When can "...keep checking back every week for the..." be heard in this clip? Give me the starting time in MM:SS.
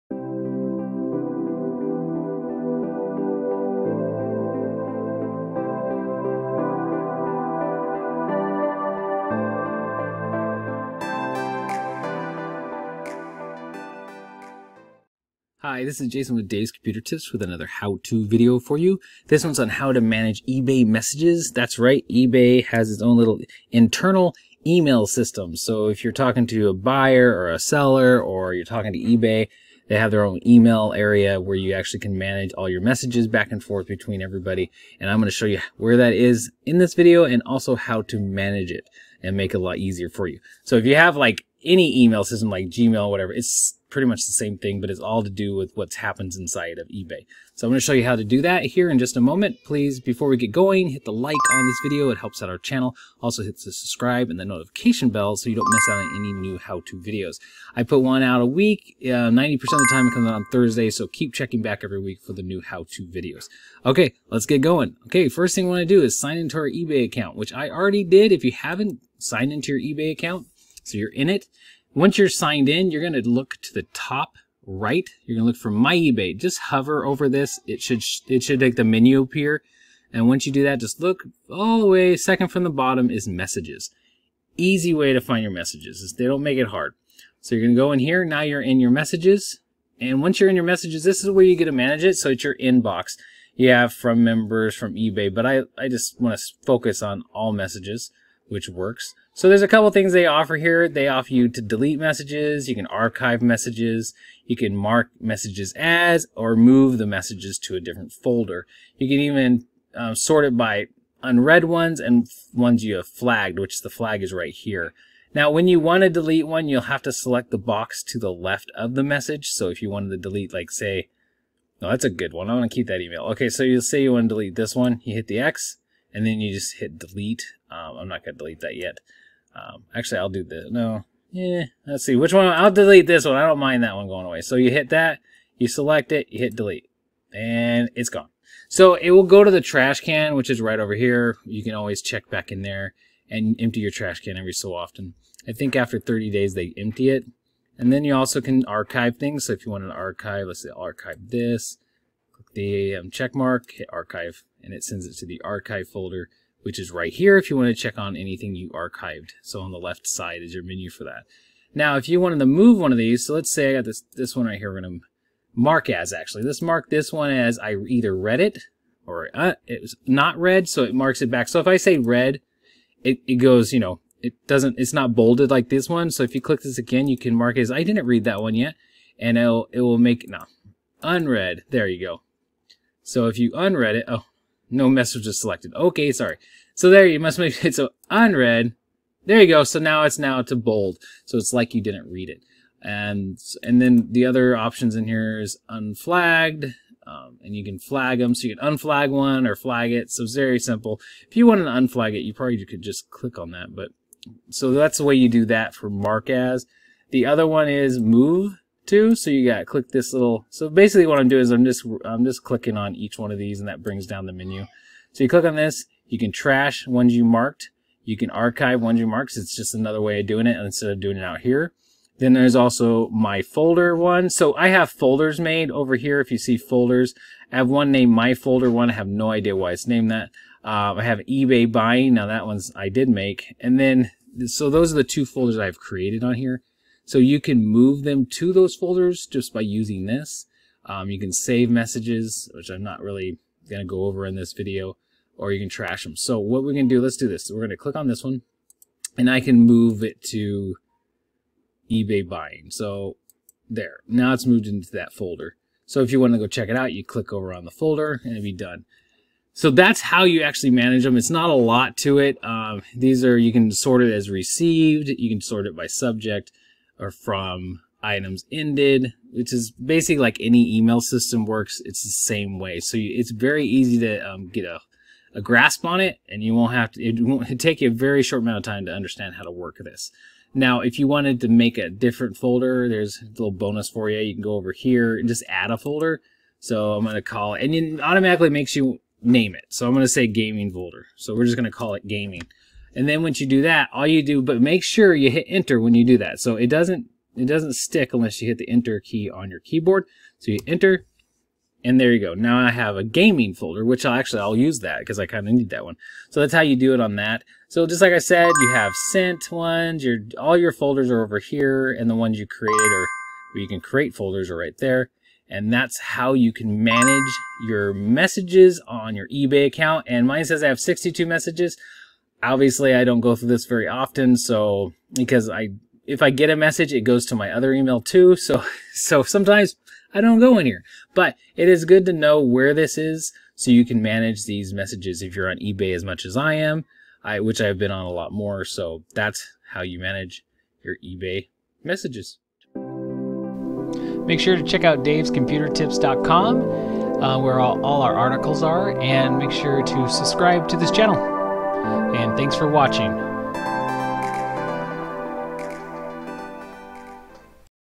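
01:01.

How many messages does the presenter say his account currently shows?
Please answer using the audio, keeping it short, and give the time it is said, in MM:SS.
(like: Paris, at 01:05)
62, at 05:20.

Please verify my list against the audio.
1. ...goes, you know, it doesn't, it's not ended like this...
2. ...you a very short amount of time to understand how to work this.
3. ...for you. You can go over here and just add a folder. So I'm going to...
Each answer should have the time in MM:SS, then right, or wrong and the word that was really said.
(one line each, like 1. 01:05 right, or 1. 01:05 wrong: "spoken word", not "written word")
1. 02:53 wrong: "bolded", not "ended"
2. 04:37 right
3. 04:43 right.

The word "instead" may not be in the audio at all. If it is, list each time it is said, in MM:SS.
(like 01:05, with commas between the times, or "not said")
03:40.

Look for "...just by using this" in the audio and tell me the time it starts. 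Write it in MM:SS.
03:59.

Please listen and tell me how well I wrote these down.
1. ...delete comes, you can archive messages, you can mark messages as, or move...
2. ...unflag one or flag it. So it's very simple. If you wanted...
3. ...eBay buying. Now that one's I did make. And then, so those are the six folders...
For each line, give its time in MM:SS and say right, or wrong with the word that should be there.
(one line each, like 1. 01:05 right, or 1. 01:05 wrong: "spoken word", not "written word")
1. 01:41 wrong: "messages", not "comes"
2. 03:18 right
3. 03:51 wrong: "two", not "six".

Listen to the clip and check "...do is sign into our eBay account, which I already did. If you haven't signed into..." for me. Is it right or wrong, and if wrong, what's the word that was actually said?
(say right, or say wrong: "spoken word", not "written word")
right.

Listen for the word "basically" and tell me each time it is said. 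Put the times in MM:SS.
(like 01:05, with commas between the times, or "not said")
03:30, 04:29.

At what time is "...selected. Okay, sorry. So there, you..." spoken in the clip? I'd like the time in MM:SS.
03:05.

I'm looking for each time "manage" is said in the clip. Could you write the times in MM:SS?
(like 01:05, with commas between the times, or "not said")
00:20, 00:32, 00:38, 01:31, 04:20, 05:16, 05:34, 05:39.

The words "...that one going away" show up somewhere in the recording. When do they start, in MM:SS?
02:13.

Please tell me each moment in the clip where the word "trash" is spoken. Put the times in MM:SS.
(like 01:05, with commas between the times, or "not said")
02:19, 02:23, 03:36, 04:05.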